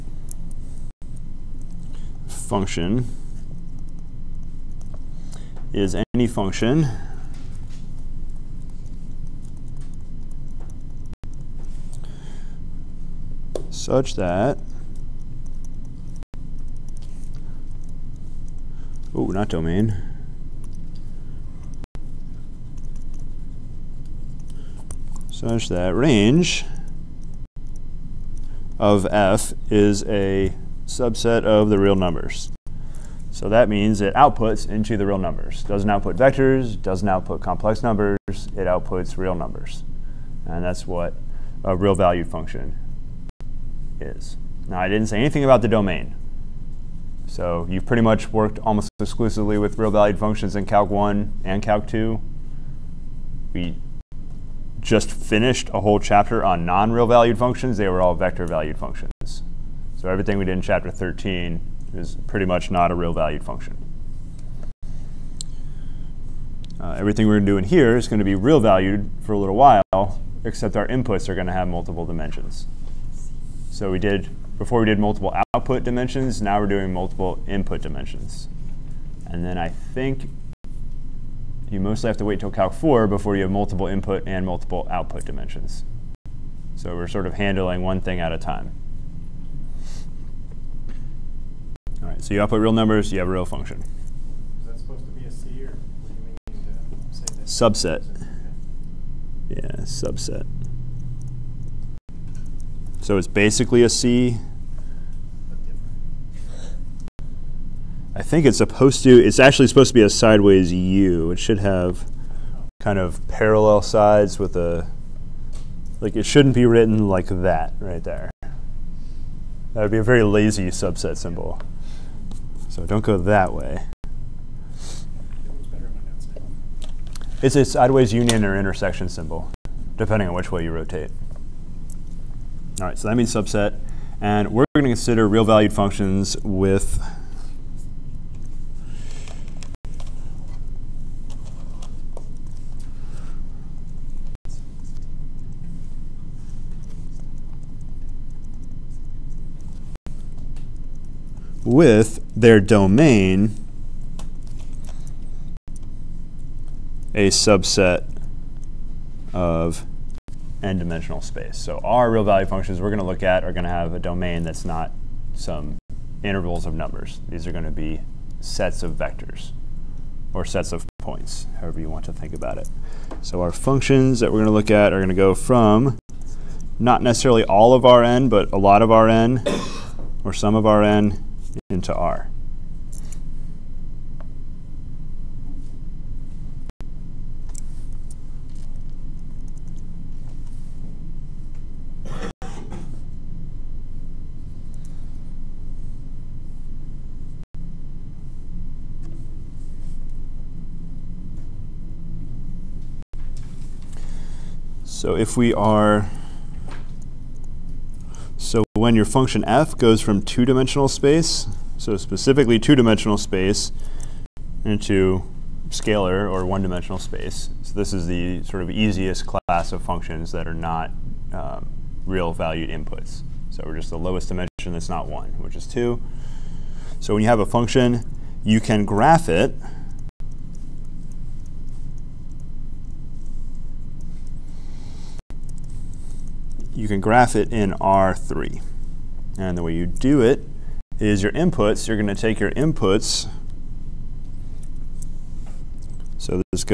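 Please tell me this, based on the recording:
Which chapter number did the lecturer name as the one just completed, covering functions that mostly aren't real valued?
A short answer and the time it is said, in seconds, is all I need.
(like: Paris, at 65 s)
13, at 60 s.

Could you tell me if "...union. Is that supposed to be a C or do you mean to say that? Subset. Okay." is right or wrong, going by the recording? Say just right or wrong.
wrong.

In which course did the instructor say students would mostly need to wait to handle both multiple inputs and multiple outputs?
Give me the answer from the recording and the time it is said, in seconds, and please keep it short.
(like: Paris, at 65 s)
Calc 4, at 82 s.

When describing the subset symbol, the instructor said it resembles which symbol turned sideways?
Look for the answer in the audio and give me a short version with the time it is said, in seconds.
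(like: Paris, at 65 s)
Union, at 128 s.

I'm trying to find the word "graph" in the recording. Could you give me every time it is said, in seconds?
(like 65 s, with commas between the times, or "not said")
228 s, 237 s.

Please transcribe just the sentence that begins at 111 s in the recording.
It should have kind of parallel sides with a, like it shouldn't be written like that right there.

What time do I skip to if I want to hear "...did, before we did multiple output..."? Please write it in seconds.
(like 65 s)
73 s.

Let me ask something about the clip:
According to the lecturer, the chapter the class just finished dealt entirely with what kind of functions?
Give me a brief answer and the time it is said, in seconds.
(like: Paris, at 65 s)
Vector valued functions, at 58 s.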